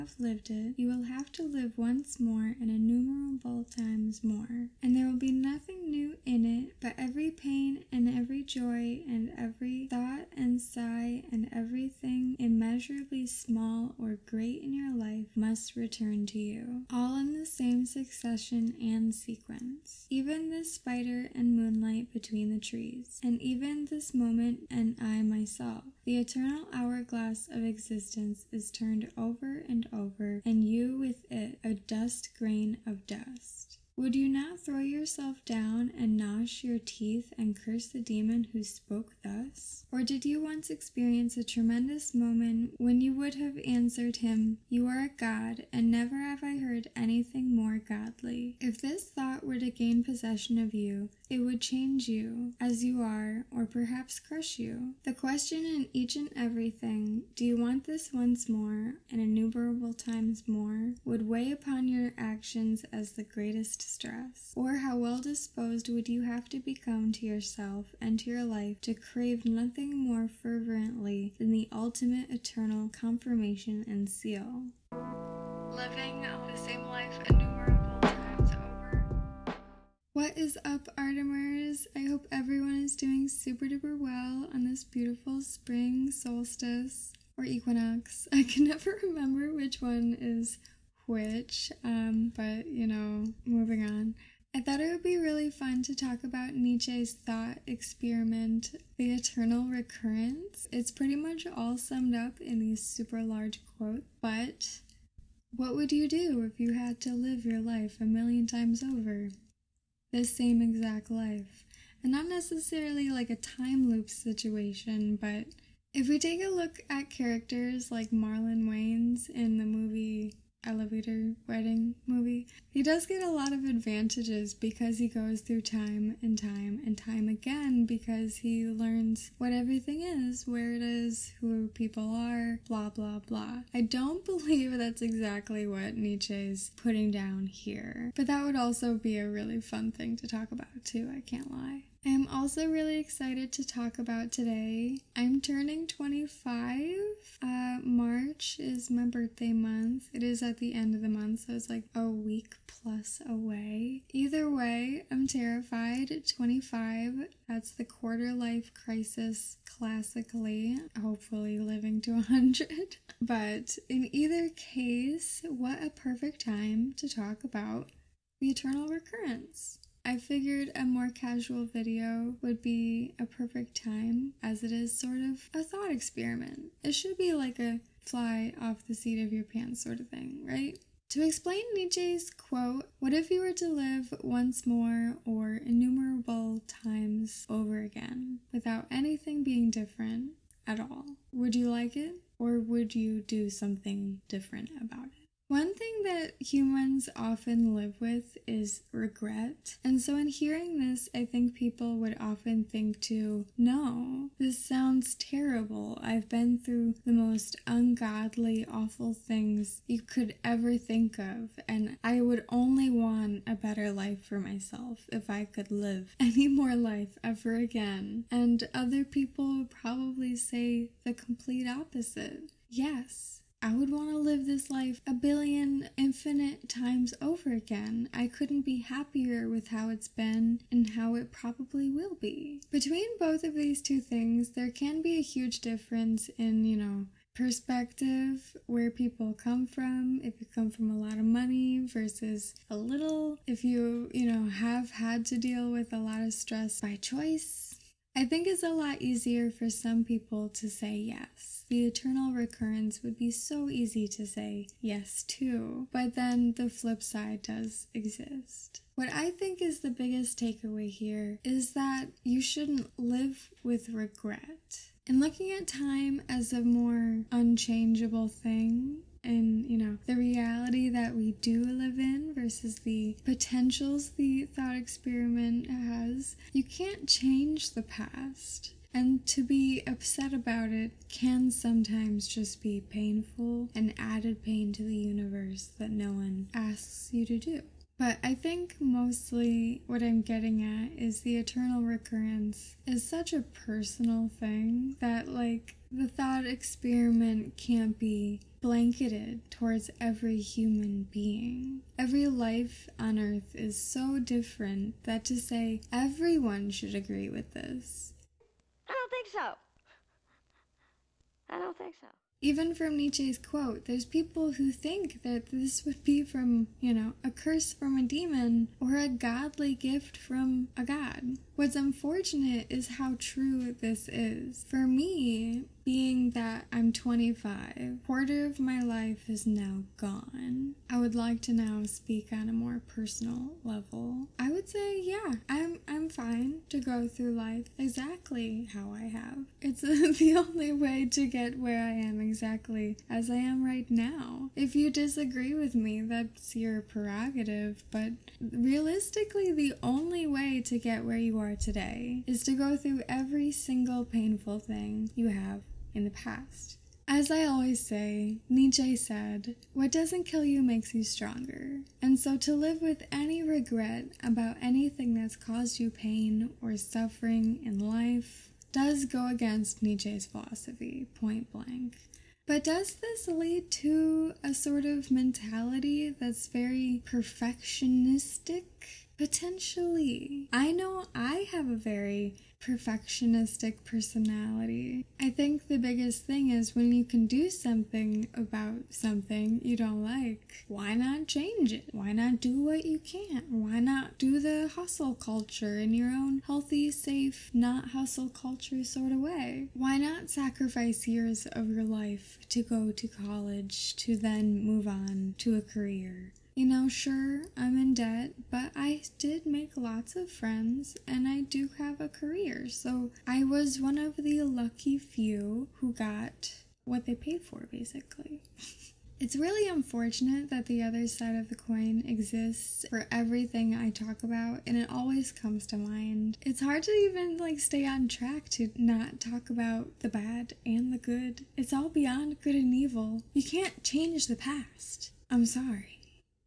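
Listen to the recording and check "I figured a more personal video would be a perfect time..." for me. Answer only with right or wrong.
wrong.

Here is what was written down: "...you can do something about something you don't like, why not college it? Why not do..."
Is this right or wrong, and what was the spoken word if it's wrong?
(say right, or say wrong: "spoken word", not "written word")
wrong: "change", not "college".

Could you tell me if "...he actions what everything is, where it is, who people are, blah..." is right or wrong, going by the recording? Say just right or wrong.
wrong.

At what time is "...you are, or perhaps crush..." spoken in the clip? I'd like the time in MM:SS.
00:52.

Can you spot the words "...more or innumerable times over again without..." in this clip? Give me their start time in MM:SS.
03:04.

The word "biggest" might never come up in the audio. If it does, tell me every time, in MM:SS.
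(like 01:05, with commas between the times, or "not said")
04:19, 06:25.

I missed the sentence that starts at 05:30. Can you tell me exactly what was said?
I would like to now speak on a more personal level.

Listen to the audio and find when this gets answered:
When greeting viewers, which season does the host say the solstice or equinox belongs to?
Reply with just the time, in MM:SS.
01:25.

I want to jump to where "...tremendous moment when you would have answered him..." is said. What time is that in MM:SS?
00:41.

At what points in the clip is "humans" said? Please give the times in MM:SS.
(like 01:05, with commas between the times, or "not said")
03:16, 05:00.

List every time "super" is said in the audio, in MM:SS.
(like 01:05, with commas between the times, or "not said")
01:23, 01:42.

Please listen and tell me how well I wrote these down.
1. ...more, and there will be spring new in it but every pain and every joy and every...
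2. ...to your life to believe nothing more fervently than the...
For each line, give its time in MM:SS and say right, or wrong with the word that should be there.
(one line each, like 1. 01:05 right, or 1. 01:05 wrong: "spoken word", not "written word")
1. 00:04 wrong: "nothing", not "spring"
2. 01:08 wrong: "crave", not "believe".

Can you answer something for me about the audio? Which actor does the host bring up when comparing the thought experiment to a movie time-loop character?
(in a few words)
Marlon Wayans.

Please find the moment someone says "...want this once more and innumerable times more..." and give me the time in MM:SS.
00:57.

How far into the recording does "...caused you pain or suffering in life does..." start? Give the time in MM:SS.
06:05.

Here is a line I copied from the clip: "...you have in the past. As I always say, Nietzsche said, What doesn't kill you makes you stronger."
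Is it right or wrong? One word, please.
right.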